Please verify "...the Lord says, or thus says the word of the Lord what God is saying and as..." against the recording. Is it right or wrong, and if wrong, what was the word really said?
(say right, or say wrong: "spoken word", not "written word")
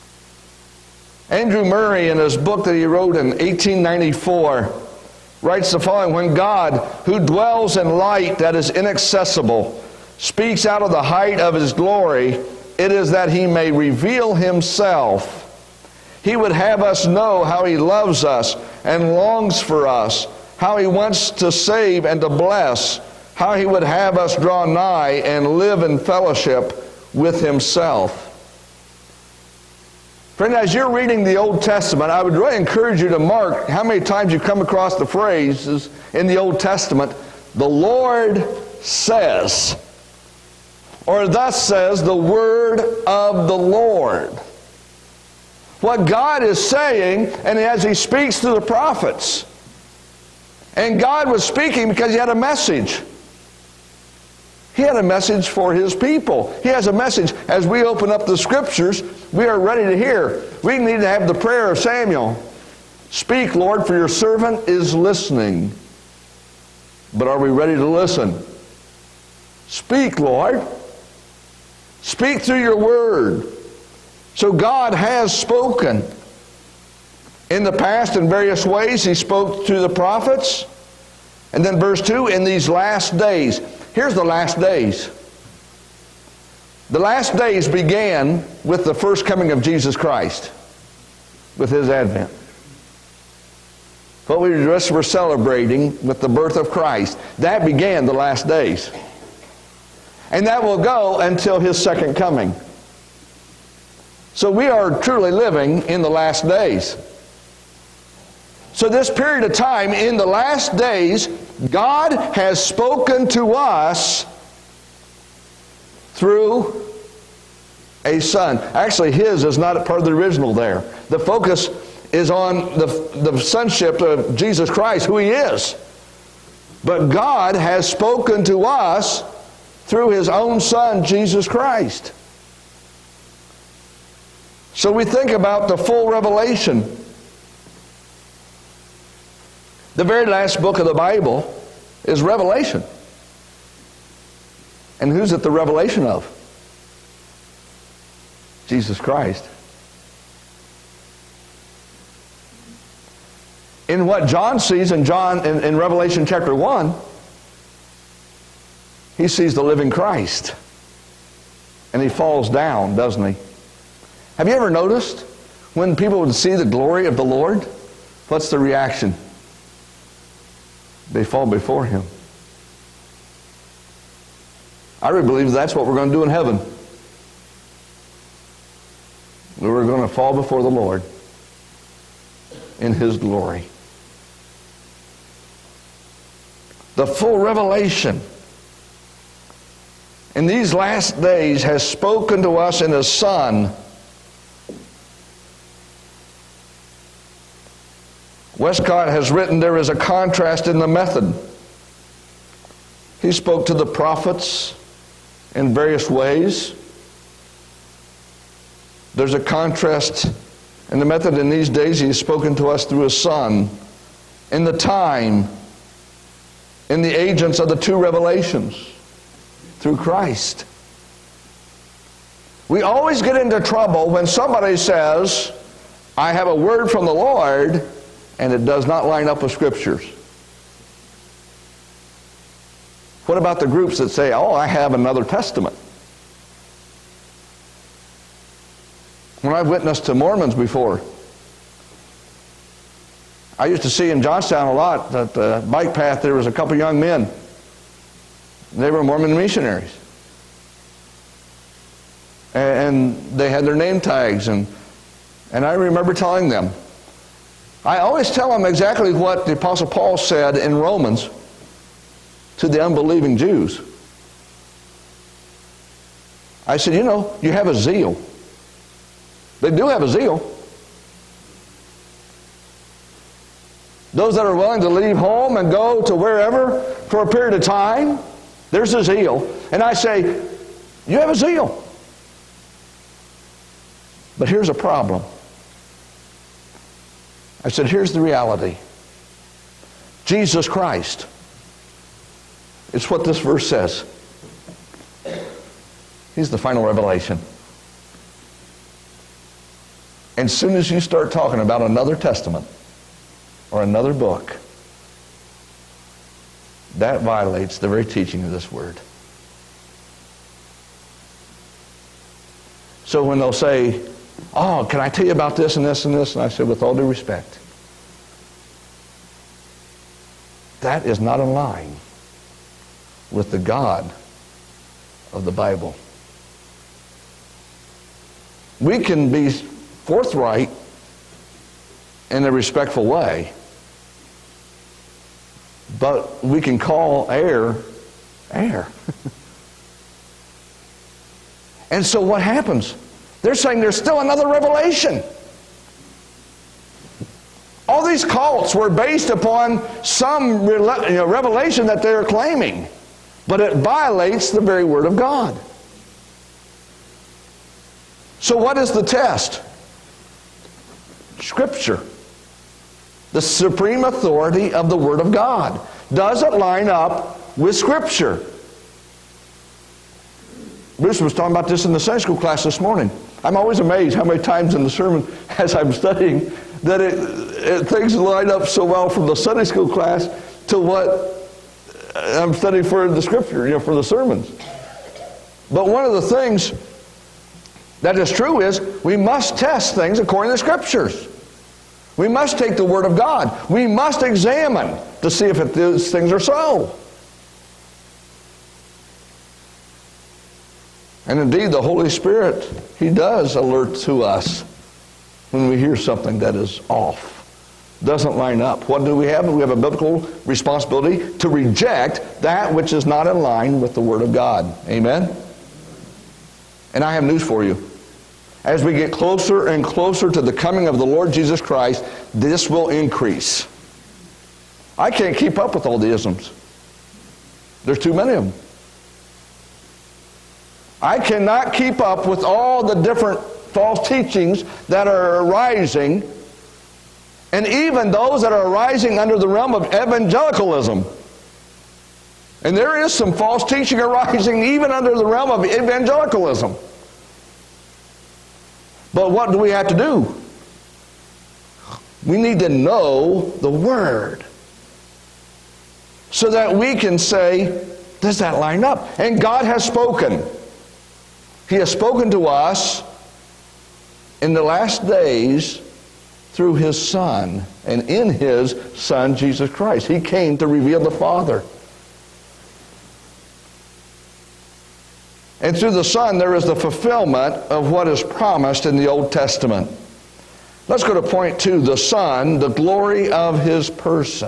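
right.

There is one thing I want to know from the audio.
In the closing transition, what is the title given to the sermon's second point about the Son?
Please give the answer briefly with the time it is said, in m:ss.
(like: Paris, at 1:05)
The glory of his person, at 8:02.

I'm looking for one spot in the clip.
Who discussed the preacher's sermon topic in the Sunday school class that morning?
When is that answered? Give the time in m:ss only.
6:10.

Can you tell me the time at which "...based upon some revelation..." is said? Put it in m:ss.
5:48.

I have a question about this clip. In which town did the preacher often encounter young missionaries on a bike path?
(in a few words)
Johnstown.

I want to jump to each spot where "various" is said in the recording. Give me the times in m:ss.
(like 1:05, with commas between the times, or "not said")
1:18, 3:25.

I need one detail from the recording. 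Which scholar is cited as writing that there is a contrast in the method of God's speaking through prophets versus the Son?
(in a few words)
Westcott.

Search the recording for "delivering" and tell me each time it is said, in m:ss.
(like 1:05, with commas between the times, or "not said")
not said.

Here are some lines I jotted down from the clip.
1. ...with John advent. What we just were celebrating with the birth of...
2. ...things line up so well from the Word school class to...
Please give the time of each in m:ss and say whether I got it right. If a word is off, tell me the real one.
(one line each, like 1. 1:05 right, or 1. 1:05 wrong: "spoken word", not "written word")
1. 1:31 wrong: "His", not "John"
2. 6:17 wrong: "Sunday", not "Word".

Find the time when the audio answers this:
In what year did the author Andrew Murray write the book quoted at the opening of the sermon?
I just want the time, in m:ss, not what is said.
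0:03.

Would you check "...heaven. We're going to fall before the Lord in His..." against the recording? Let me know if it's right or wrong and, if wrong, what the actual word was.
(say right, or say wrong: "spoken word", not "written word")
right.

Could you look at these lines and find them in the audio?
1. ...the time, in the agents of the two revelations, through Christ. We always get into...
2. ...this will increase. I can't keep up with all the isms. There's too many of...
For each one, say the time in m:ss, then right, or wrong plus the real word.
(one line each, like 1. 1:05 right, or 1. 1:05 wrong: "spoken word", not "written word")
1. 3:34 right
2. 7:02 right.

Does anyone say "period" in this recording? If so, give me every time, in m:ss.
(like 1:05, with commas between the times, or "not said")
1:49, 4:37.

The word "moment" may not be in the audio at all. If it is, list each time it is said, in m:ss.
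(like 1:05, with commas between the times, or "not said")
not said.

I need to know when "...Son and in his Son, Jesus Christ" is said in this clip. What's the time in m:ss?
7:47.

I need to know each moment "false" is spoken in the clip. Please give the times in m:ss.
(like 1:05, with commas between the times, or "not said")
7:13, 7:23.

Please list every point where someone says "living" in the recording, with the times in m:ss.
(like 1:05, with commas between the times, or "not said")
1:45, 2:39.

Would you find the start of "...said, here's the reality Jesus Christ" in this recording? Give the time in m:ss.
4:47.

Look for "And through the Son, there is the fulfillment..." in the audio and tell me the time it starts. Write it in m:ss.
7:55.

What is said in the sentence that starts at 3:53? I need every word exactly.
What about the groups that say, oh, I have another testament?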